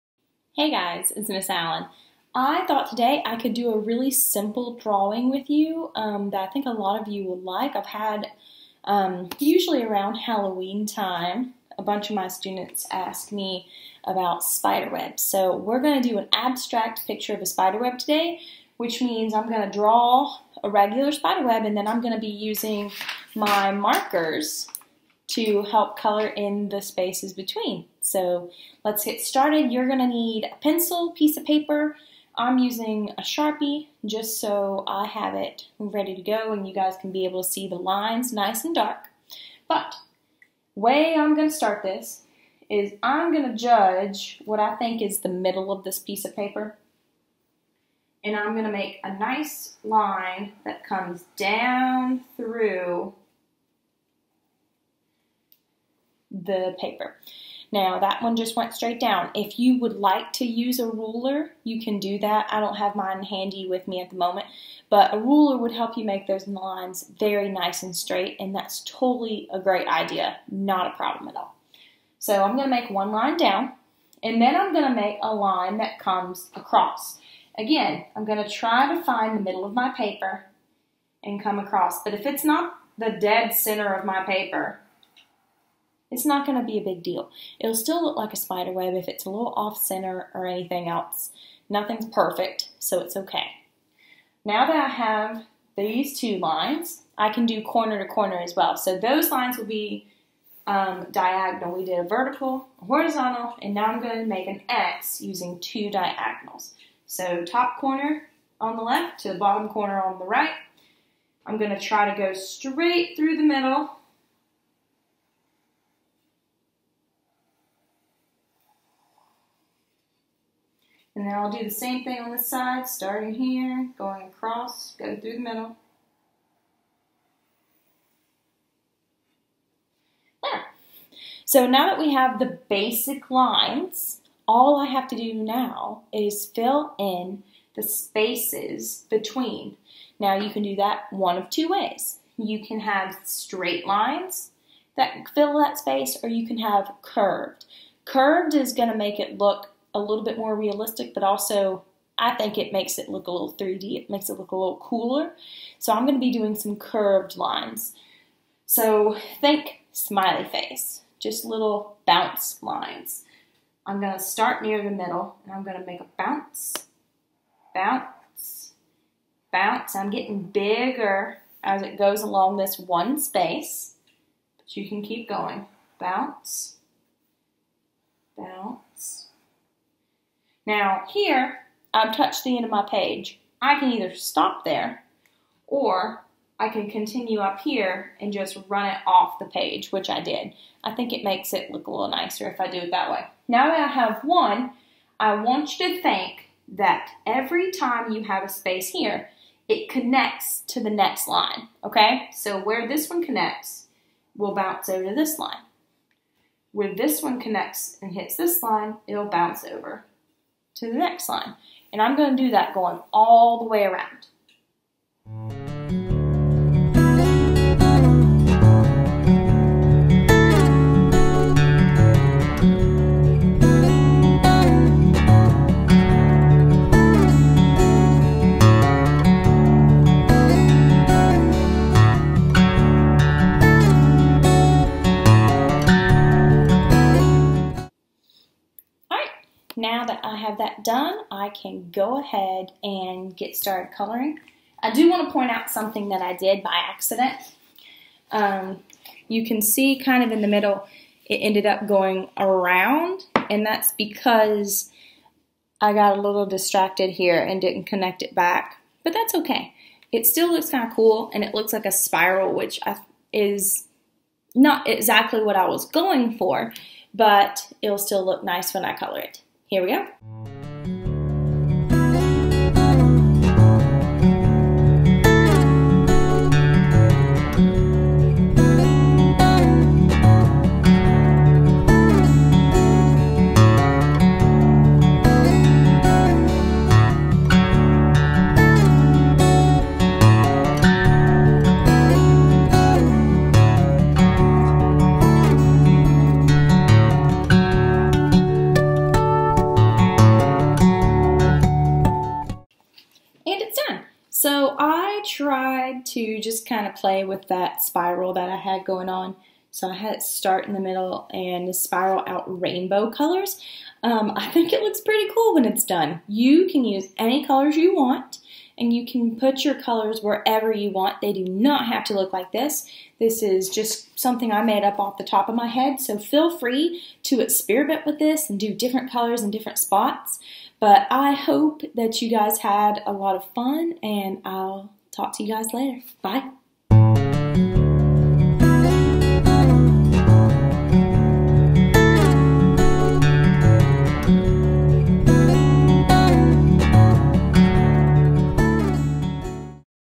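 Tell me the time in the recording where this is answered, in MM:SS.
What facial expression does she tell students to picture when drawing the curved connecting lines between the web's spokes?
02:39.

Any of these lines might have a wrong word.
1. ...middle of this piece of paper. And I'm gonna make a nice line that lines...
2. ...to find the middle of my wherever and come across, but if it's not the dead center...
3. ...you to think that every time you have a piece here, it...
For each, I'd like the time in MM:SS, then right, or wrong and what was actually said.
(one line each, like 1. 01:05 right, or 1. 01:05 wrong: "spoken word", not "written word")
1. 00:45 wrong: "comes", not "lines"
2. 01:18 wrong: "paper", not "wherever"
3. 03:15 wrong: "space", not "piece".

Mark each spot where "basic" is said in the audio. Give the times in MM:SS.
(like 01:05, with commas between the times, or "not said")
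02:12.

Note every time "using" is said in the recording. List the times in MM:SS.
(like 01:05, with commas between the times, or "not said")
00:22, 00:32, 01:45.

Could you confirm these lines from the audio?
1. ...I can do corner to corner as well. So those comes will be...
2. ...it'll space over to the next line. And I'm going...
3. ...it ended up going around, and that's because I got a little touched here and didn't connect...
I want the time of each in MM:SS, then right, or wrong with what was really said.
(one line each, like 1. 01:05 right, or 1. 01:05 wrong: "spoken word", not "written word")
1. 01:37 wrong: "lines", not "comes"
2. 03:29 wrong: "bounce", not "space"
3. 04:11 wrong: "distracted", not "touched".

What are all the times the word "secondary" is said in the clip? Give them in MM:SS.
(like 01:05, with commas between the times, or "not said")
not said.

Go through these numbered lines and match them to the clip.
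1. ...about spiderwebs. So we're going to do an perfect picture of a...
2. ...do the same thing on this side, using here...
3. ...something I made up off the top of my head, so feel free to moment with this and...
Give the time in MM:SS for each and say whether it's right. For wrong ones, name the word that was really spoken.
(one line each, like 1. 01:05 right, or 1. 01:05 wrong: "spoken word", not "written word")
1. 00:14 wrong: "abstract", not "perfect"
2. 02:01 wrong: "starting", not "using"
3. 05:24 wrong: "experiment", not "moment".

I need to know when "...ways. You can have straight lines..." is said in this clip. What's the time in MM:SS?
02:21.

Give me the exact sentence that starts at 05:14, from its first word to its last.
Um, I think it looks pretty cool when it's done.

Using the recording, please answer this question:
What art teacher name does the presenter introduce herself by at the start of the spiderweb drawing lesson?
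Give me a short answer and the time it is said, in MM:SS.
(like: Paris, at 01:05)
Miss Allen, at 00:01.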